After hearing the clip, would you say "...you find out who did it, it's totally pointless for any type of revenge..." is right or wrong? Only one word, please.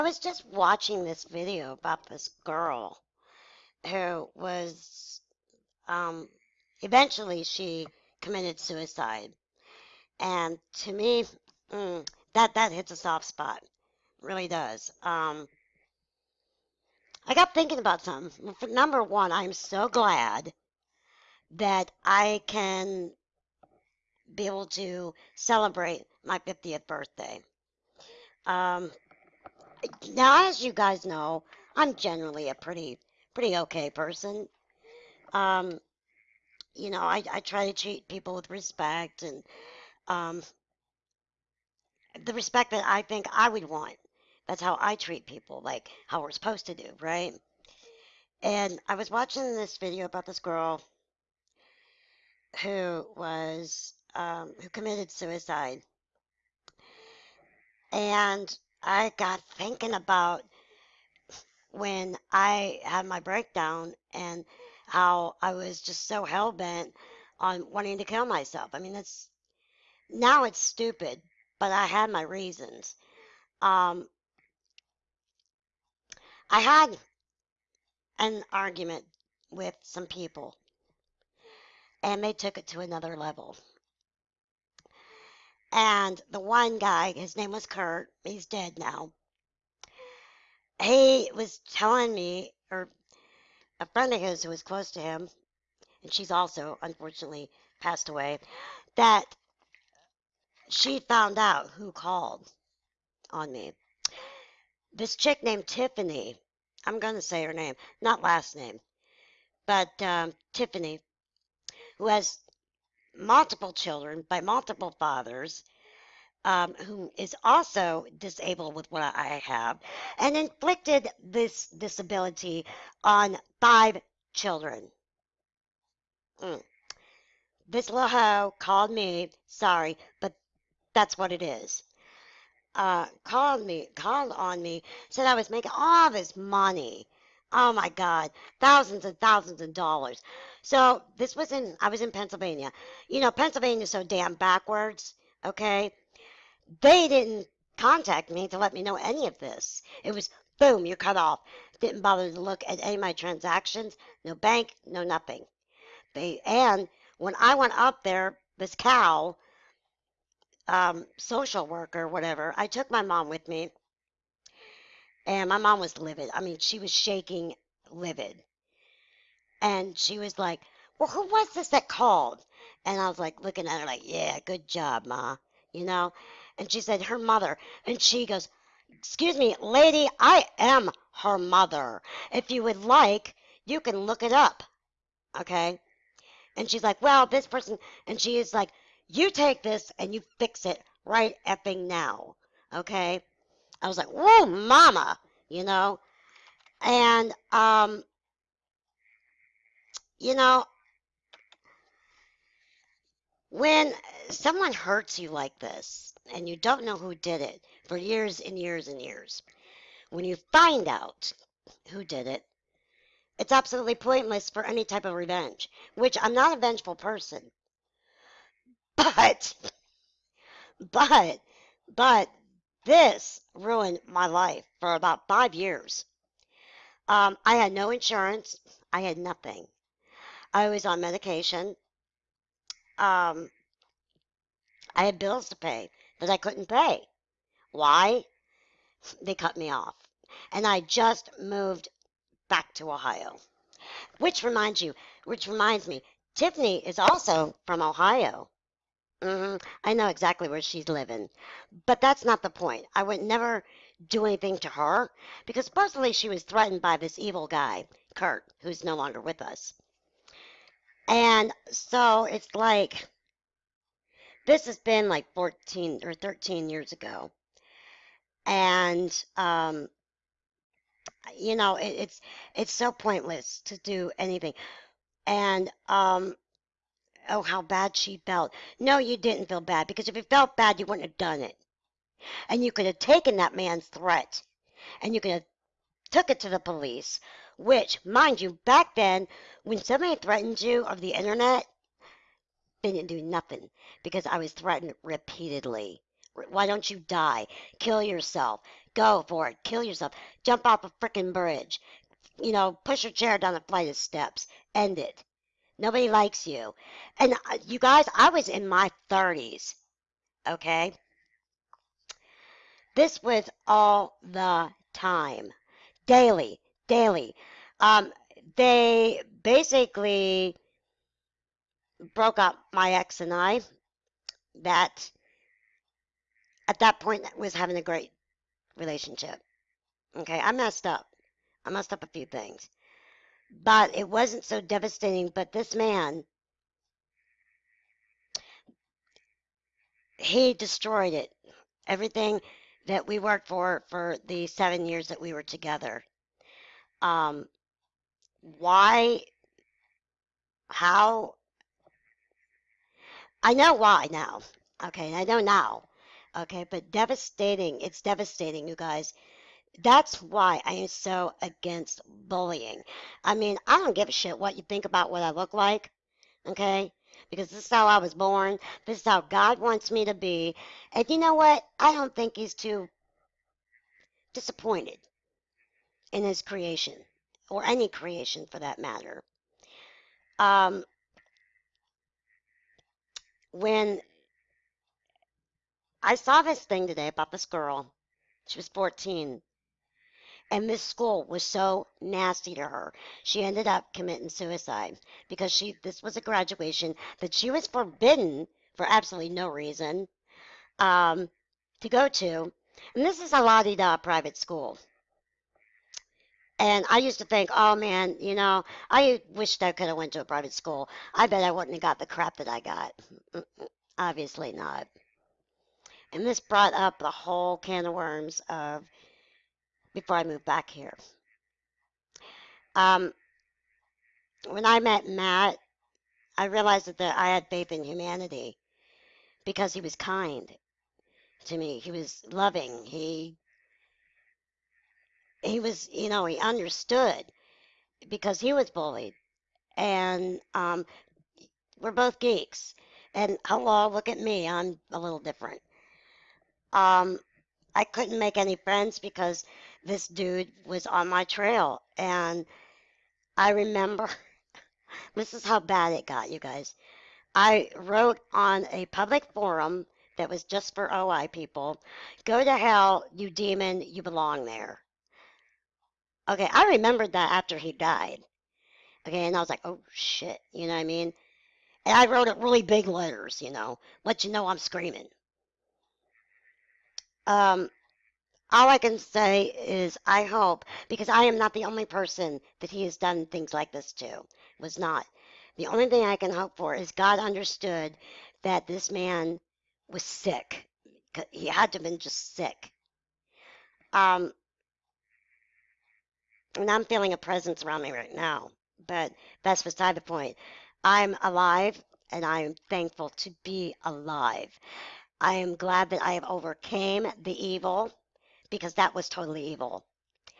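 wrong.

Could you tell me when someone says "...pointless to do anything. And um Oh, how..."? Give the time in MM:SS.
04:32.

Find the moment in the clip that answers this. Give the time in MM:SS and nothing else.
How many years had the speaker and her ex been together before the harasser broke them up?
05:44.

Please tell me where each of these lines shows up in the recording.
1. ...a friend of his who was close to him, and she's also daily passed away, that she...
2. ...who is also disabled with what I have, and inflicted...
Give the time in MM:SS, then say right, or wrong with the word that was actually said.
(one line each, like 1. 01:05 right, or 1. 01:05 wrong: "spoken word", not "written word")
1. 01:33 wrong: "unfortunately", not "daily"
2. 01:56 right.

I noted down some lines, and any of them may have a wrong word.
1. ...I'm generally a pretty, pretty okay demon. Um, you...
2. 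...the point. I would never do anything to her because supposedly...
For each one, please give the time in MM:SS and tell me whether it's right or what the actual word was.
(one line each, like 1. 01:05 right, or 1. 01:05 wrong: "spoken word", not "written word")
1. 00:31 wrong: "person", not "demon"
2. 04:12 right.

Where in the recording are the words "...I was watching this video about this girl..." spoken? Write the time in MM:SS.
00:48.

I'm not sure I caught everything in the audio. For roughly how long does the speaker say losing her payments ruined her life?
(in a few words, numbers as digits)
5 years.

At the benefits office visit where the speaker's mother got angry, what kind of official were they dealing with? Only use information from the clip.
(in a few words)
social worker.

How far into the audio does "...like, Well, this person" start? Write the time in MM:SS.
03:06.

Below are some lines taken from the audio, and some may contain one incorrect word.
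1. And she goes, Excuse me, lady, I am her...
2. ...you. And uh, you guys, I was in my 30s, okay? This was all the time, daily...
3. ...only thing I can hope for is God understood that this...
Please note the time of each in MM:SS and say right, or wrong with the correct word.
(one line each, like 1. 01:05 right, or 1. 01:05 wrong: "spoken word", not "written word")
1. 02:57 right
2. 05:06 right
3. 08:05 right.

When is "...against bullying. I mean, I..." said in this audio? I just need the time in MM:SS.
06:01.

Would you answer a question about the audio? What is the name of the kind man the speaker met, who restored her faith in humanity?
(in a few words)
Matt.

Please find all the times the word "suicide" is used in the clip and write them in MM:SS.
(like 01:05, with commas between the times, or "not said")
00:08, 00:55, 06:34.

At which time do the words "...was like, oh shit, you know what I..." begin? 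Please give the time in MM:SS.
07:49.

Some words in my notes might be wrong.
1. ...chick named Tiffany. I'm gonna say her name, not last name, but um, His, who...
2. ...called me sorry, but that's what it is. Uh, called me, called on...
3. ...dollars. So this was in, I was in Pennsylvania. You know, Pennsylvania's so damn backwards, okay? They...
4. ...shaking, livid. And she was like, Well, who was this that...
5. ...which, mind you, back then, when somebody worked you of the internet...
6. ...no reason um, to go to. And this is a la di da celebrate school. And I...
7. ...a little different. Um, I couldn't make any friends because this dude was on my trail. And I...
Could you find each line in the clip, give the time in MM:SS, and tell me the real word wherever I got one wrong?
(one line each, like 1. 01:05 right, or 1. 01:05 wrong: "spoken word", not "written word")
1. 01:45 wrong: "Tiffany", not "His"
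2. 02:08 right
3. 02:19 right
4. 02:46 right
5. 04:47 wrong: "threatened", not "worked"
6. 06:39 wrong: "private", not "celebrate"
7. 07:24 right.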